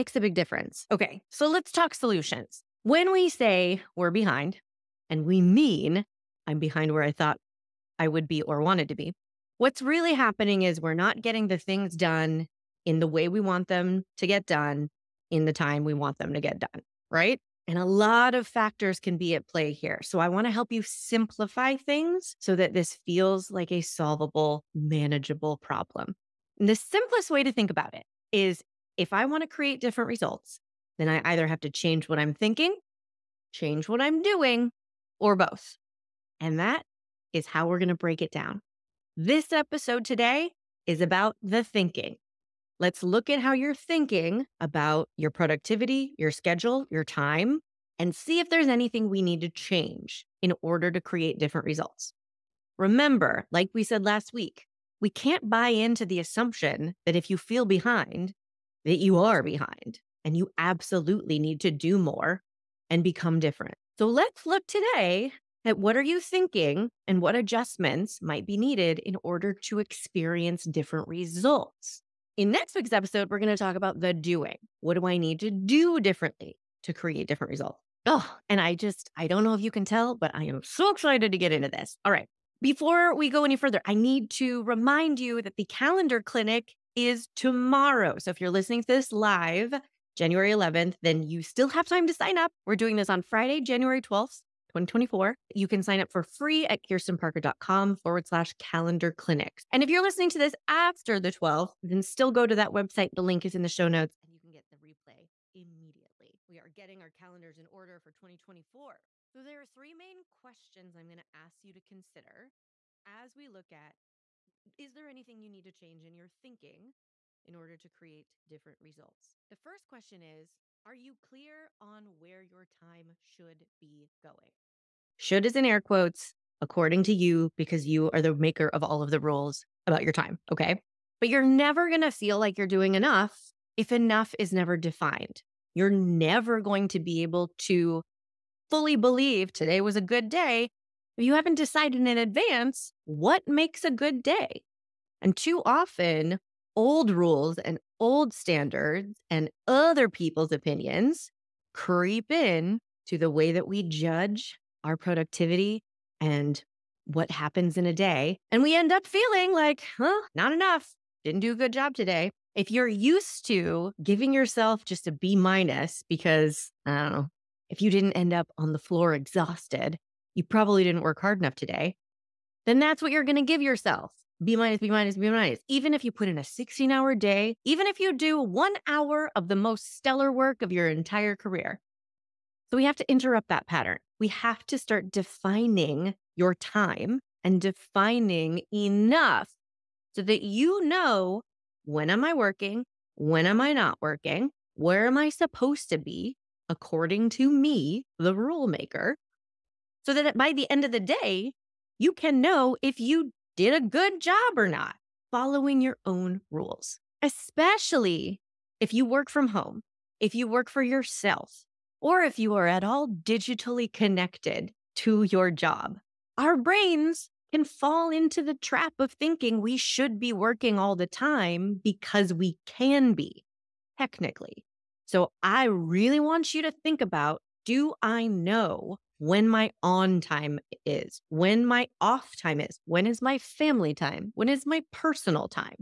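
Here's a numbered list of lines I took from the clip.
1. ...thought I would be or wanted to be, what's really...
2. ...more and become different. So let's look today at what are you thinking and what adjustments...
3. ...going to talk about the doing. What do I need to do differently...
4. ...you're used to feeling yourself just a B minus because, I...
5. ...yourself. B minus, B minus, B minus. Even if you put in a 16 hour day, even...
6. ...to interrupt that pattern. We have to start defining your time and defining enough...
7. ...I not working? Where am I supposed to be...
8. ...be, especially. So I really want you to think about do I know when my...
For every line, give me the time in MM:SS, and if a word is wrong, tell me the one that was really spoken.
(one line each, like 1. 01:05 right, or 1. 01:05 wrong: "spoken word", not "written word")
1. 00:07 right
2. 01:01 right
3. 01:13 right
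4. 02:42 wrong: "giving", not "feeling"
5. 02:53 right
6. 03:02 right
7. 03:13 right
8. 03:43 wrong: "technically", not "especially".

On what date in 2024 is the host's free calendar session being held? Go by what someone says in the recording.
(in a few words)
January 12th.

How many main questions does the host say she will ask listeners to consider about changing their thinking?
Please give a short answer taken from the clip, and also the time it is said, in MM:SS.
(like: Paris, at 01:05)
3, at 01:49.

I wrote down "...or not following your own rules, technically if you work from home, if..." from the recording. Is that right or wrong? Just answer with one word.
wrong.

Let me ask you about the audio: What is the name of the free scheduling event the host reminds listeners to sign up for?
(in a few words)
calendar clinic.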